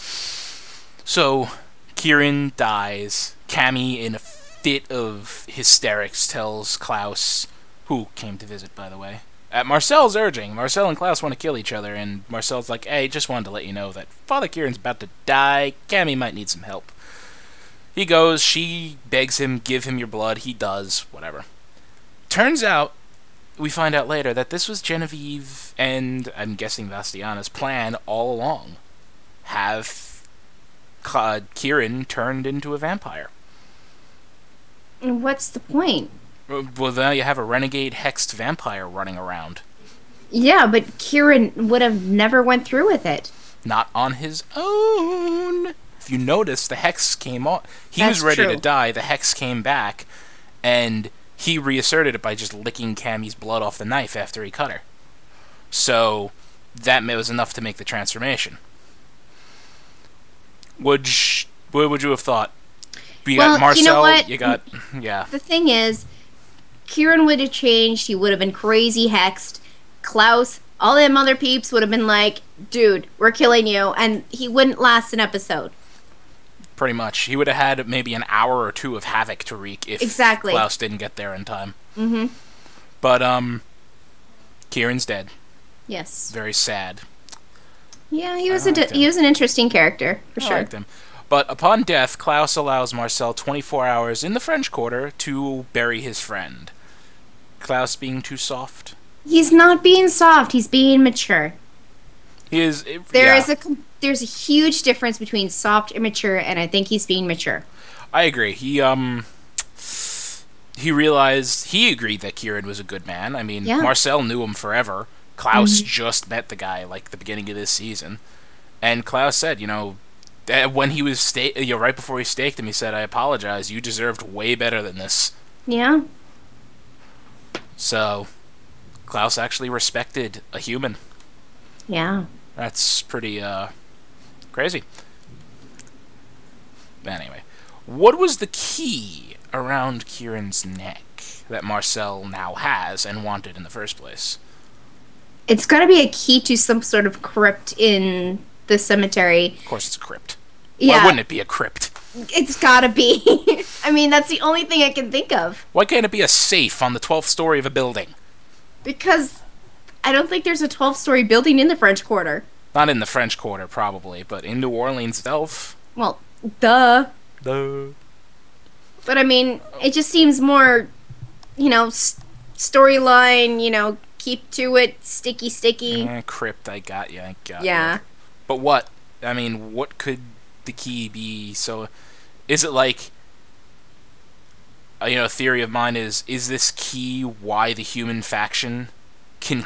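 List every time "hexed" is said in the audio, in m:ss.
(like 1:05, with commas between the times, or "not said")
0:37, 1:09.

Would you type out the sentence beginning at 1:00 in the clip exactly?
Would what would you have thought?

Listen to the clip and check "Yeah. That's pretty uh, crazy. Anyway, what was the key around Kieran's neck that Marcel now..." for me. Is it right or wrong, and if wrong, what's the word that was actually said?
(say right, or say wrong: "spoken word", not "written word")
right.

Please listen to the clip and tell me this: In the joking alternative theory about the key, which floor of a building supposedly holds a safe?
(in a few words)
12th.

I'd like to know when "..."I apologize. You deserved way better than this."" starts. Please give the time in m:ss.
2:02.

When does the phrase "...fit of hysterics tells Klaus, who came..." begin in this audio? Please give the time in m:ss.
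0:04.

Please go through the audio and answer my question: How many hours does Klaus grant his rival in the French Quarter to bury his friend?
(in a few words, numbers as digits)
24.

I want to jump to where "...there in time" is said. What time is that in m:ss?
1:21.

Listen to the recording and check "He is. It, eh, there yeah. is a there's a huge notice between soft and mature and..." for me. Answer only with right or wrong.
wrong.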